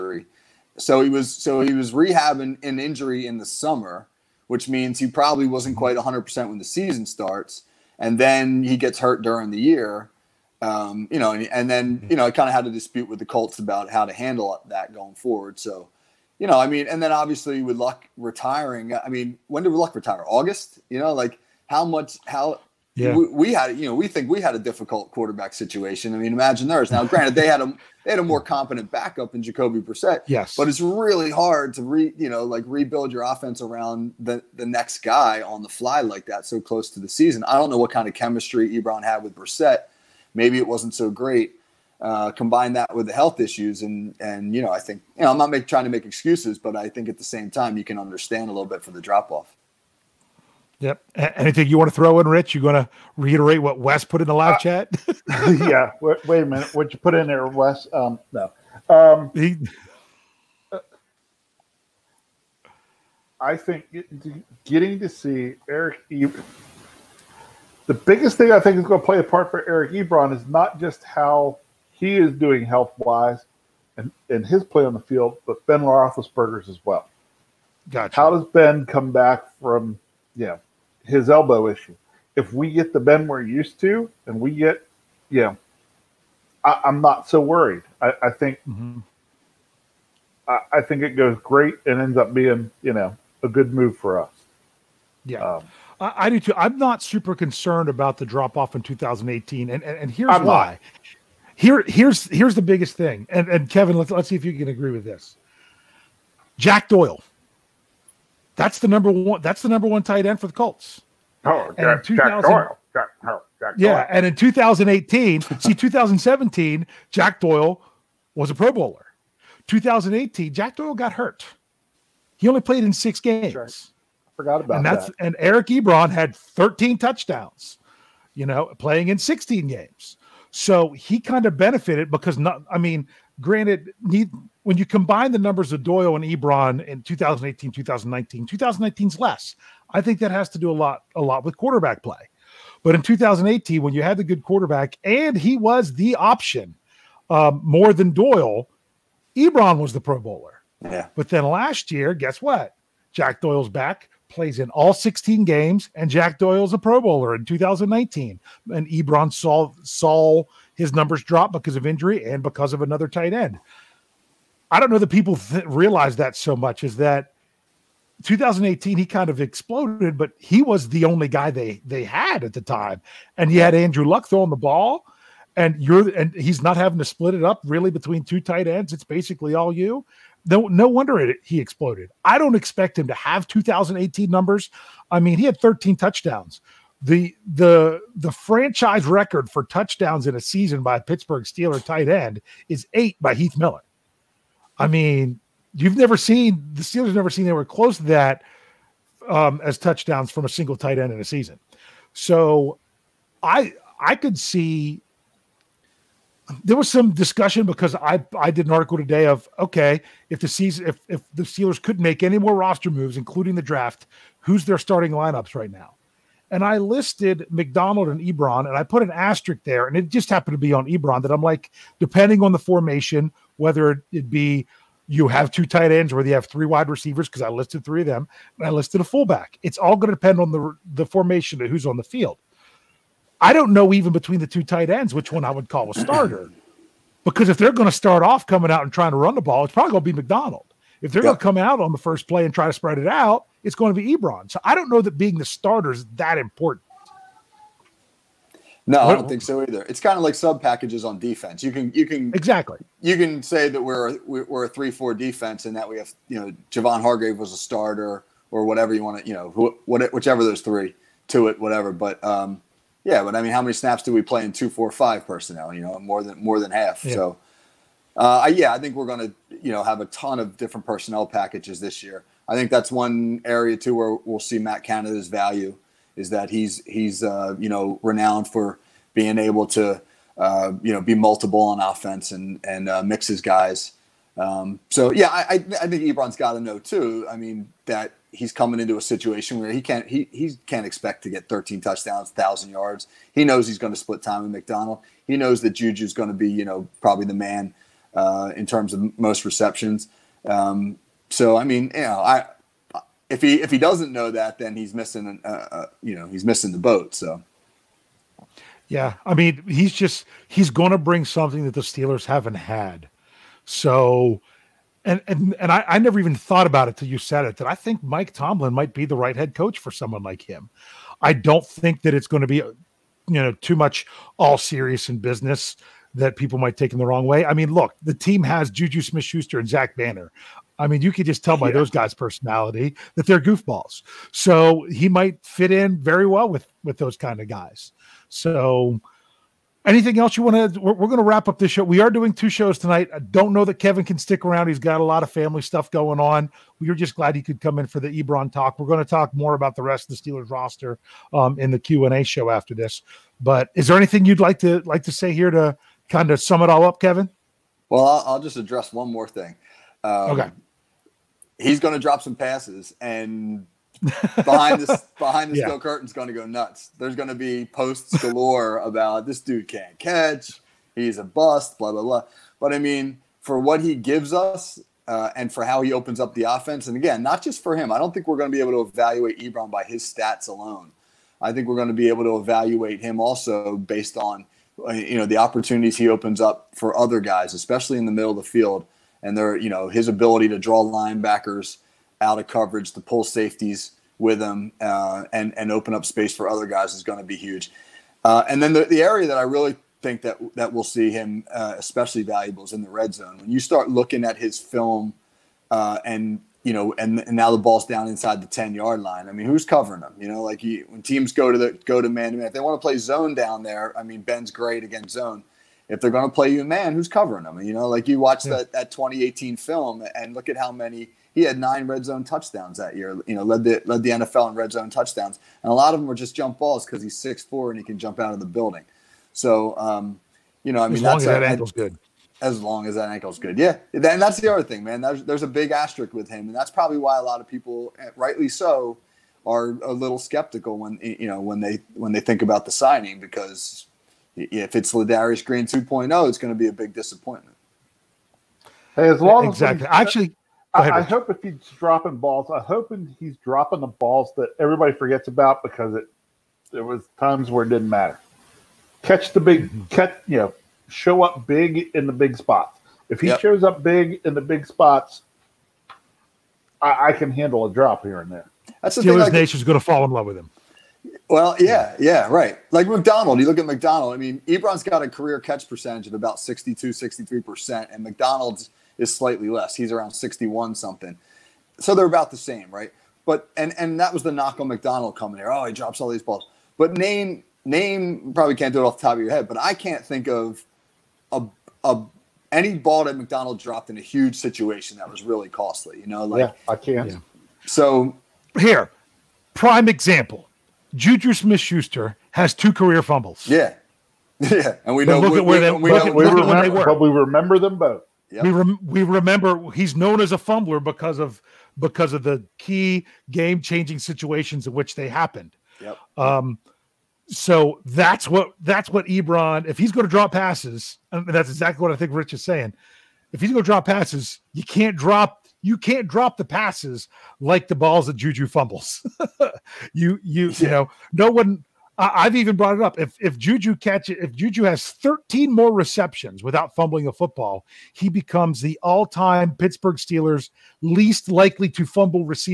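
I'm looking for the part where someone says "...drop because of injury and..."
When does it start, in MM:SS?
02:41.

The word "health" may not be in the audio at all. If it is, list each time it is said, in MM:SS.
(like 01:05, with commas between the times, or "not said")
00:43, 01:12.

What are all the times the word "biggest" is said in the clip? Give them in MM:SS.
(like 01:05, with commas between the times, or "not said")
01:07, 01:42.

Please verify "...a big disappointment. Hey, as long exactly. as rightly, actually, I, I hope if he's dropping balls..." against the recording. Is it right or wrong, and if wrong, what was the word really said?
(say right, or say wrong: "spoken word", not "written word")
wrong: "exactly", not "rightly".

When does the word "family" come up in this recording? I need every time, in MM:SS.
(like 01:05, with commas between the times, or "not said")
05:45.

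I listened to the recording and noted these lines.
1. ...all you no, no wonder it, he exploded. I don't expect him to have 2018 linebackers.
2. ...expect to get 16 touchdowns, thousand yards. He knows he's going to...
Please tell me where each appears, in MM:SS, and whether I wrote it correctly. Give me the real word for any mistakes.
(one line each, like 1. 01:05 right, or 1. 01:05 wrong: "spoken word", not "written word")
1. 02:59 wrong: "numbers", not "linebackers"
2. 04:50 wrong: "13", not "16".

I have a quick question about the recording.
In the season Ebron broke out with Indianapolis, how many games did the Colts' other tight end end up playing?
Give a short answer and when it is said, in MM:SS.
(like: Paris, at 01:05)
6, at 02:02.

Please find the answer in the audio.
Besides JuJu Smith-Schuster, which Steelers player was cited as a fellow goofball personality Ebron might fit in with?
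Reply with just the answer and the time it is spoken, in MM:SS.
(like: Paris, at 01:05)
Zach Banner, at 05:29.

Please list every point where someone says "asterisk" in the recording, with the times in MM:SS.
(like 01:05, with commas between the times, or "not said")
03:39, 07:15.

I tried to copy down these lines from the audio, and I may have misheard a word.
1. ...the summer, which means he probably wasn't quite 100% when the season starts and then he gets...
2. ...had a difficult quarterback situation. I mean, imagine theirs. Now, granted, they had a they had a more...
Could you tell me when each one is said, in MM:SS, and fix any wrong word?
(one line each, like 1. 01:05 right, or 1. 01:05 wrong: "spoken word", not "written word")
1. 00:03 right
2. 00:24 right.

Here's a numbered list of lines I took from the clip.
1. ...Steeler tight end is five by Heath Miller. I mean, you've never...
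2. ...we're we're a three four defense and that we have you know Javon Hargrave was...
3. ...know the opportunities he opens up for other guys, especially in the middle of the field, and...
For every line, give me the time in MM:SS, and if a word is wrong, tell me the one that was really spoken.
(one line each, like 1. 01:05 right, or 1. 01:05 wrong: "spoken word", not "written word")
1. 03:11 wrong: "eight", not "five"
2. 04:13 right
3. 06:25 right.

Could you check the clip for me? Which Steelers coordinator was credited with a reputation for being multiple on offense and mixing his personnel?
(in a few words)
Matt Canada.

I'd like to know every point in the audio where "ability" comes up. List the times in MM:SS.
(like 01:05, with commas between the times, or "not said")
06:30.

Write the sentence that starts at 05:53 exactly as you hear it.
But is there anything you'd like to like to say here to kind of sum it all up, Kevin?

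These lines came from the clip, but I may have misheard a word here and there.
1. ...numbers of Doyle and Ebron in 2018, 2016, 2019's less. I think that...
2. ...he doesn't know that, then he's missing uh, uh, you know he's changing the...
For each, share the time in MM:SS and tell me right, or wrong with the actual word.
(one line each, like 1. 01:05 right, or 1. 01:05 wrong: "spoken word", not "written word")
1. 02:15 wrong: "2019", not "2016"
2. 05:03 wrong: "missing", not "changing".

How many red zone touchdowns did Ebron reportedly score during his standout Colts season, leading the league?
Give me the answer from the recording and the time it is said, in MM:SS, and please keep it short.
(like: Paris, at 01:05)
9, at 07:01.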